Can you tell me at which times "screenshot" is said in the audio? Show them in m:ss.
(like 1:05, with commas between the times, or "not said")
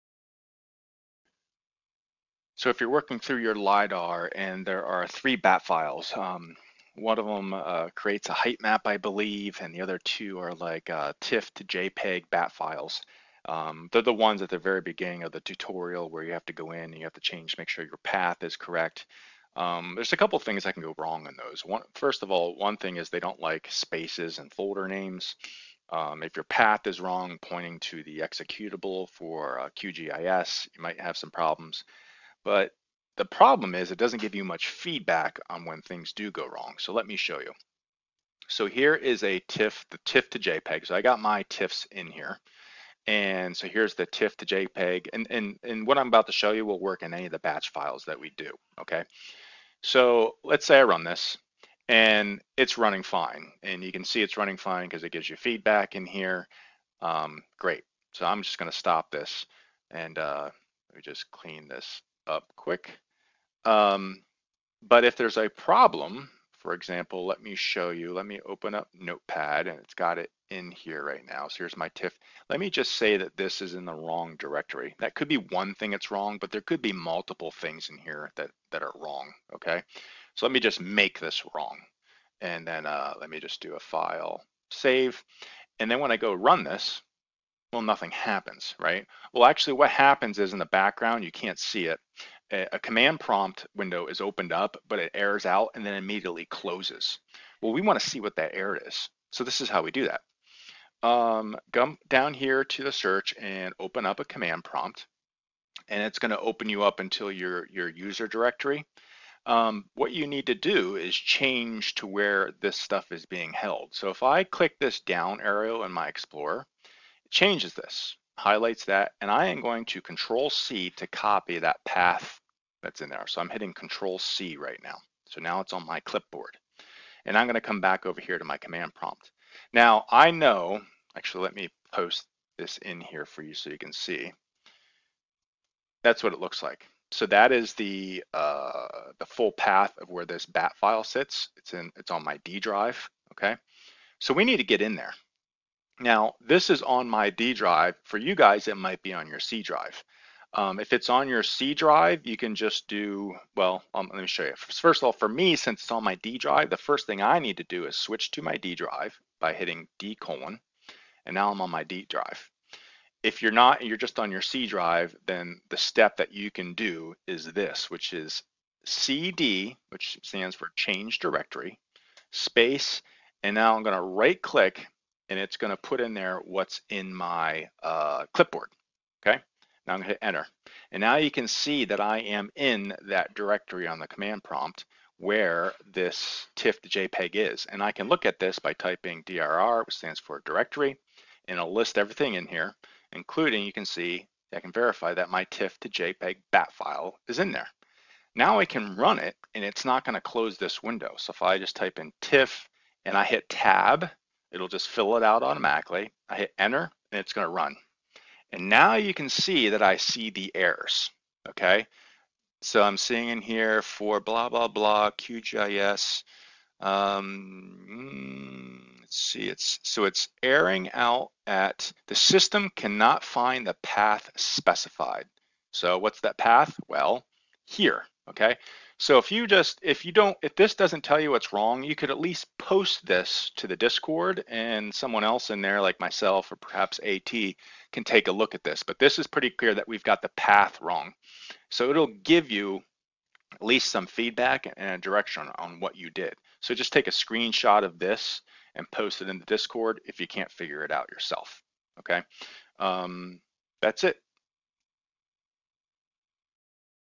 4:07.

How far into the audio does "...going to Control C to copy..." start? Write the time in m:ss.
1:59.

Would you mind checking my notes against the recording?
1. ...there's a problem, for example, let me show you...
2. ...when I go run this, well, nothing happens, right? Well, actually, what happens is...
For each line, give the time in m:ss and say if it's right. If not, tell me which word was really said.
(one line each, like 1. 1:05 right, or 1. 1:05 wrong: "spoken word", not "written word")
1. 1:05 right
2. 1:25 right.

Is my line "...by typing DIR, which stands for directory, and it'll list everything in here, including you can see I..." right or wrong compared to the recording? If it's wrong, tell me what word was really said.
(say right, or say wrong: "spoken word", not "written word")
right.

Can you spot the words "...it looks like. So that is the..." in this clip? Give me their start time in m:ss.
2:16.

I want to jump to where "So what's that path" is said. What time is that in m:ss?
3:45.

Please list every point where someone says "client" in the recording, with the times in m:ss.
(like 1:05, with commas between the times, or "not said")
not said.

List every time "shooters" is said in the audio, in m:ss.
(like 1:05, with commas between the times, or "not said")
not said.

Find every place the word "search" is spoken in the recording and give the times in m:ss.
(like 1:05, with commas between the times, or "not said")
1:42.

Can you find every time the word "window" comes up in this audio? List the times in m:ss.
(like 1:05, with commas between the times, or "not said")
1:33, 3:20.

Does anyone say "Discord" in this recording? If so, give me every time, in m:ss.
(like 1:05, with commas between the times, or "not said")
3:53, 4:09.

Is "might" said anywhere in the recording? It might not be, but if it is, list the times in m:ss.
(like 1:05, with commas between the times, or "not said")
0:30, 2:28.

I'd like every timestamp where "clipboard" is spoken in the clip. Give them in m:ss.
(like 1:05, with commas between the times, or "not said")
2:06, 2:58.